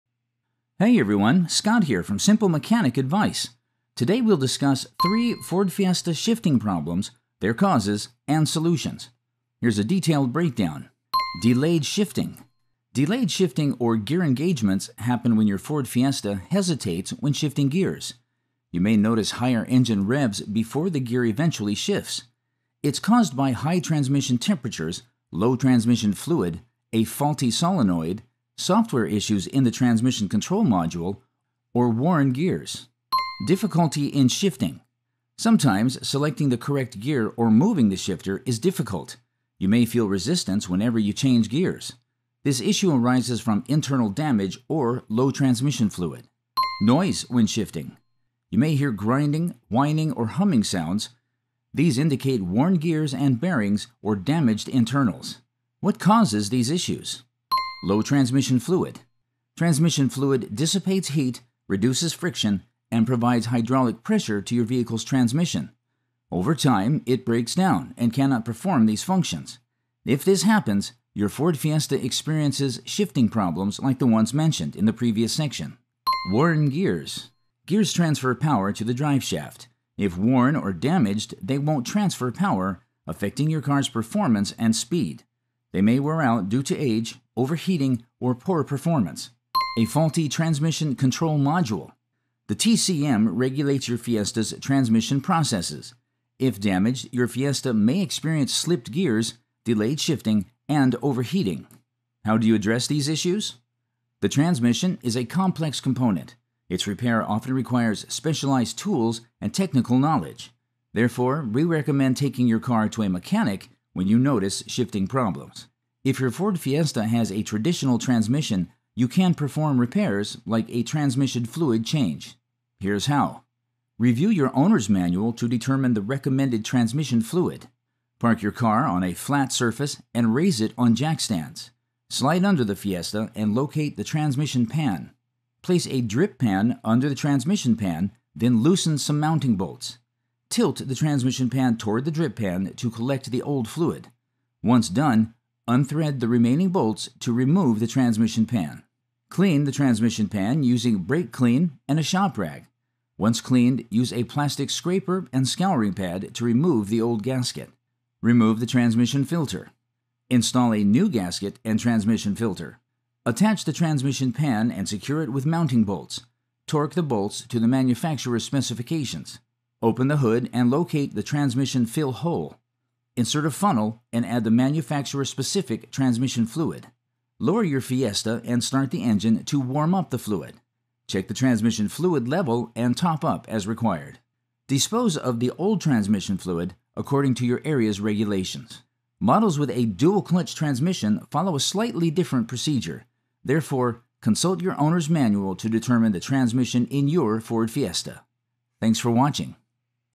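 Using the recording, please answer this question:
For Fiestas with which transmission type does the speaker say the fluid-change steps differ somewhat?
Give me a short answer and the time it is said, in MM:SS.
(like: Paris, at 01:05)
dual clutch transmission, at 03:09.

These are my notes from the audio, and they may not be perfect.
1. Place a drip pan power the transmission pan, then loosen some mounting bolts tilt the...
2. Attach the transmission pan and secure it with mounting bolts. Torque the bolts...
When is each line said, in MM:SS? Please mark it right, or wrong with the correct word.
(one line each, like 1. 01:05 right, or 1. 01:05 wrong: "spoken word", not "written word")
1. 02:15 wrong: "under", not "power"
2. 02:43 right.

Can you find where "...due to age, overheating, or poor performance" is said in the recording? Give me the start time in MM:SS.
01:26.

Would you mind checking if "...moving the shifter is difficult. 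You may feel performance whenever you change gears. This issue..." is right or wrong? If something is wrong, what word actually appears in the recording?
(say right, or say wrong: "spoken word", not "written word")
wrong: "resistance", not "performance".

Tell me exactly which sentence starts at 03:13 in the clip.
Therefore, consult your owner's manual to determine the transmission in your Ford Fiesta.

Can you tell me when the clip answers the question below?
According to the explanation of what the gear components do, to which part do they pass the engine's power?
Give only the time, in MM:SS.
01:18.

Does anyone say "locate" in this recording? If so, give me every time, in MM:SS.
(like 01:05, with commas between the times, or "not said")
02:13, 02:50.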